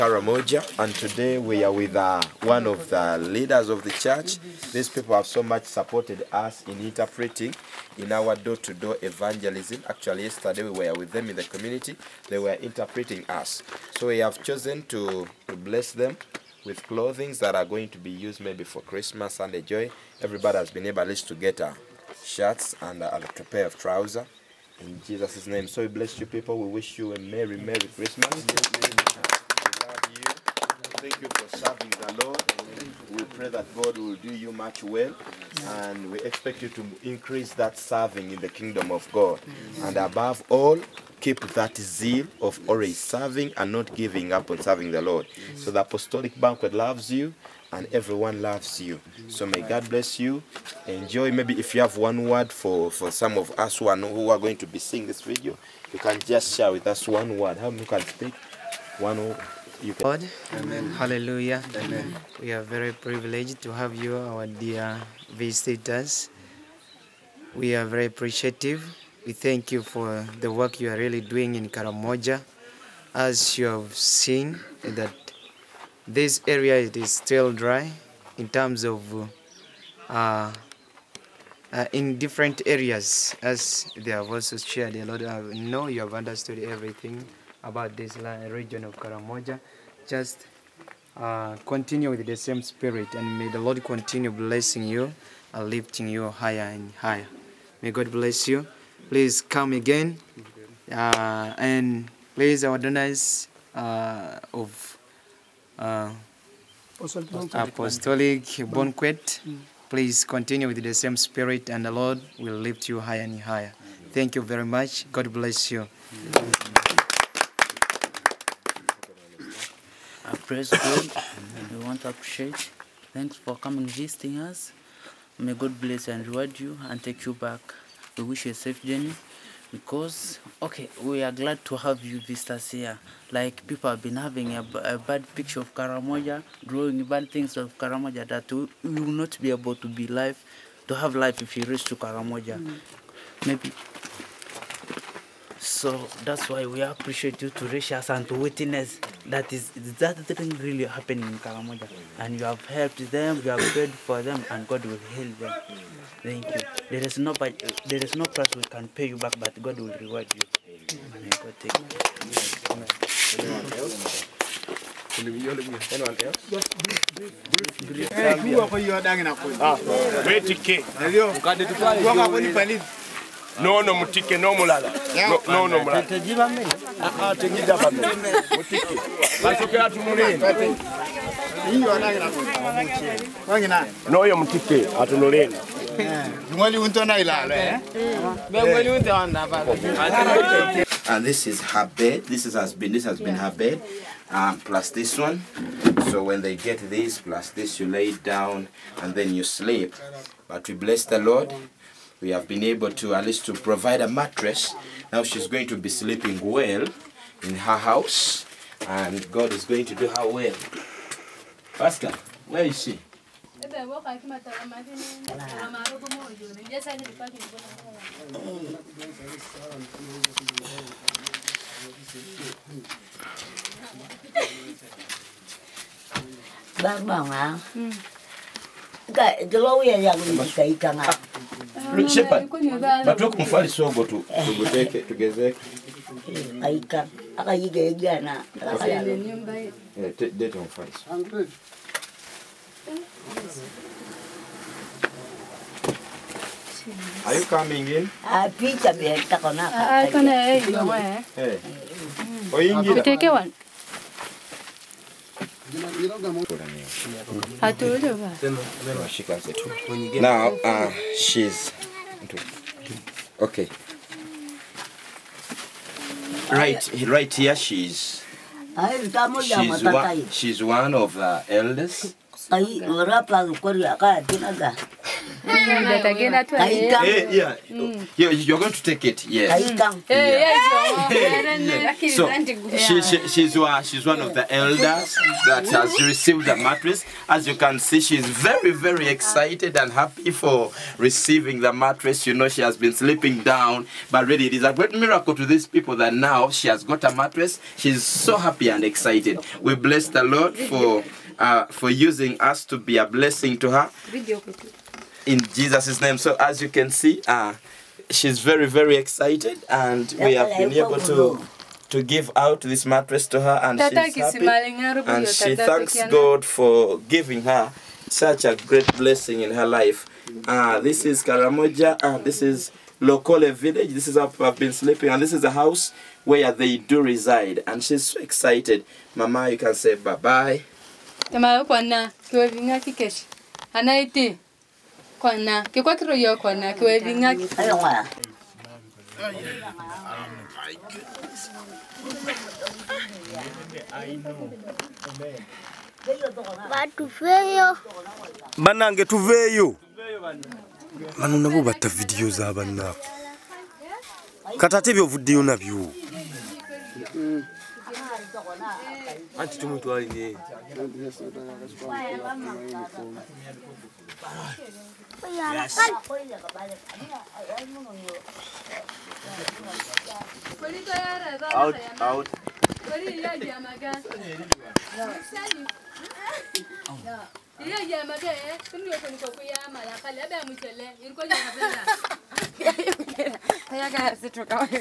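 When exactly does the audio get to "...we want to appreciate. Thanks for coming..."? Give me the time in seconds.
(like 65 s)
121 s.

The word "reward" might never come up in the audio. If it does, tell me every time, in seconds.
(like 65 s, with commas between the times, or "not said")
126 s, 159 s.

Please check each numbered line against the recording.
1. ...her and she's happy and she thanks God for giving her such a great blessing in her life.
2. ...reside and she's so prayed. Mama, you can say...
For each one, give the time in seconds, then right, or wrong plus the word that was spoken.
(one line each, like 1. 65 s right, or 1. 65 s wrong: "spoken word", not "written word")
1. 313 s right
2. 326 s wrong: "excited", not "prayed".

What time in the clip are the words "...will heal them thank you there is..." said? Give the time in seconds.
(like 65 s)
154 s.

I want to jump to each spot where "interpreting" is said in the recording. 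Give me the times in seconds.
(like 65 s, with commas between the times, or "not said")
6 s, 12 s.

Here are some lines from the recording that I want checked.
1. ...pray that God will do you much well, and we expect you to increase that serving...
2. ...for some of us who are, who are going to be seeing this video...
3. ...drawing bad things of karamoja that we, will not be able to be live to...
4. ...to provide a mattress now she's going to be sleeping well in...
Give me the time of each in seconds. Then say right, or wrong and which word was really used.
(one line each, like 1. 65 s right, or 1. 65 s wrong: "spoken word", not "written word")
1. 33 s right
2. 52 s right
3. 136 s right
4. 203 s right.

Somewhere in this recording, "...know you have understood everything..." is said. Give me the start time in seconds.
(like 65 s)
85 s.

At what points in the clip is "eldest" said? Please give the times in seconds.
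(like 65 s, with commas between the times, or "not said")
271 s.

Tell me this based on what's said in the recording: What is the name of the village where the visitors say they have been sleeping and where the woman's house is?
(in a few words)
Lokole.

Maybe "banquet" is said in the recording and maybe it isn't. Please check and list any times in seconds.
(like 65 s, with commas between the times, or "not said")
46 s, 108 s.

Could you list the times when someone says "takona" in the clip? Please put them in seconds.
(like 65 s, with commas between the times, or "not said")
249 s.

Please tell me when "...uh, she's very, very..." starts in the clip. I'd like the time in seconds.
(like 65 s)
307 s.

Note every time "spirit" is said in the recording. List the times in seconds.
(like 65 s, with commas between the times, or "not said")
92 s, 111 s.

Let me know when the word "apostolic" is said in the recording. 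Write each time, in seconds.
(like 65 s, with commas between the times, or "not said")
45 s, 106 s.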